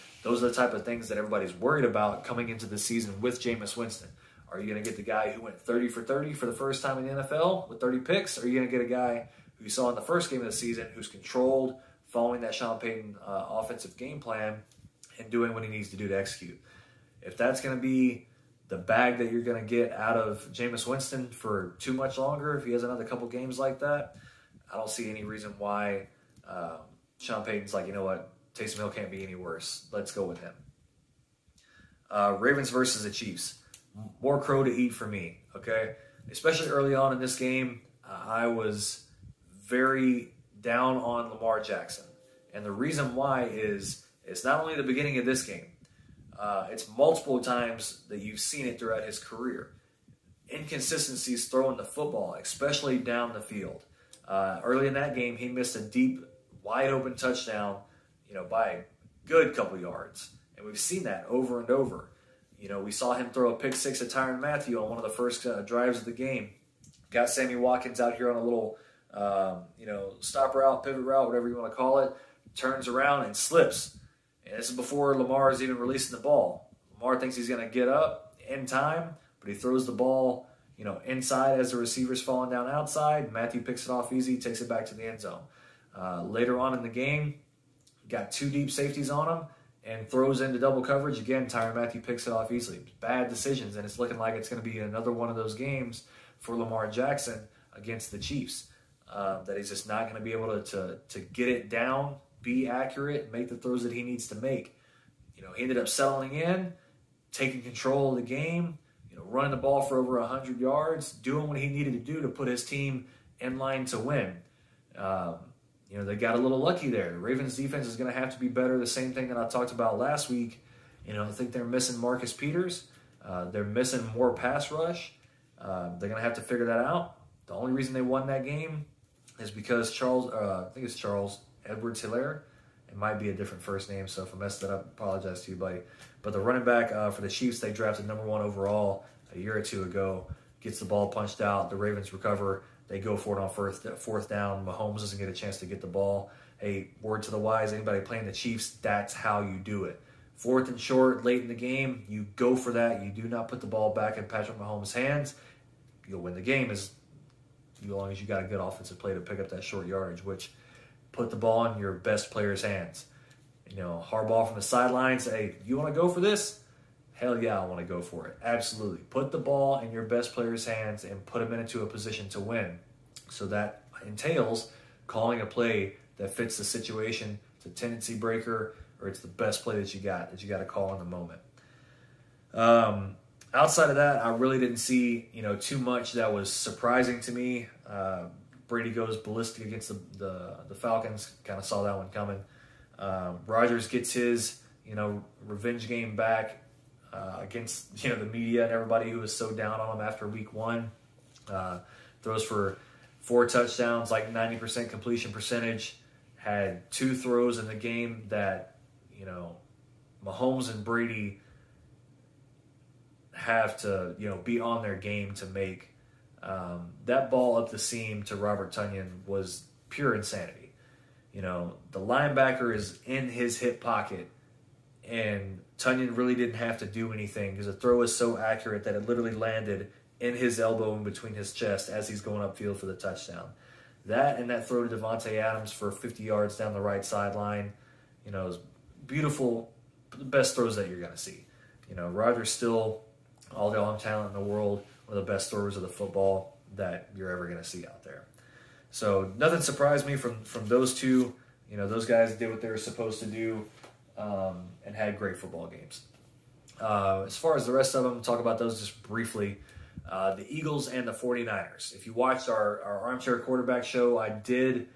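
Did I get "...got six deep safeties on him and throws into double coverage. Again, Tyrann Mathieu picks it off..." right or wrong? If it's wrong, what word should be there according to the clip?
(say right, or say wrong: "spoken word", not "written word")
wrong: "two", not "six".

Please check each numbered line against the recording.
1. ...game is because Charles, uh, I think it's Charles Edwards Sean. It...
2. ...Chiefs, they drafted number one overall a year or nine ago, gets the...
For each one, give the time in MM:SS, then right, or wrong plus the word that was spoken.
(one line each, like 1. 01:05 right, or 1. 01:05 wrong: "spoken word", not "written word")
1. 02:08 wrong: "Helaire", not "Sean"
2. 02:17 wrong: "two", not "nine".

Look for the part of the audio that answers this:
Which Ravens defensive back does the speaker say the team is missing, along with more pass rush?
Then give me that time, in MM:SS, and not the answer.
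02:02.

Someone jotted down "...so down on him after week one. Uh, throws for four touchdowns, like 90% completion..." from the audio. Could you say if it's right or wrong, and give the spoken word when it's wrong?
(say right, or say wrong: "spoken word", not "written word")
right.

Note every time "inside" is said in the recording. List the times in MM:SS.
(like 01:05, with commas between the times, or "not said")
01:21.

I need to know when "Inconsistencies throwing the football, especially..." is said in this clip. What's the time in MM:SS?
00:50.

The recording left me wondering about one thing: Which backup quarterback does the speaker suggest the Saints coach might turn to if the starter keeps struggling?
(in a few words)
Taysom Hill.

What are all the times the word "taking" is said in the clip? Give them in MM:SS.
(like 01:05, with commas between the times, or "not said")
01:47.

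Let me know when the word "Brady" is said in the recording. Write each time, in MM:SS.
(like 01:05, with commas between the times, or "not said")
03:08, 03:30.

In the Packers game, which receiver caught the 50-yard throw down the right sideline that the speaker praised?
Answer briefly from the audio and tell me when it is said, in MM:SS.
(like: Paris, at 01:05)
Davante Adams, at 03:54.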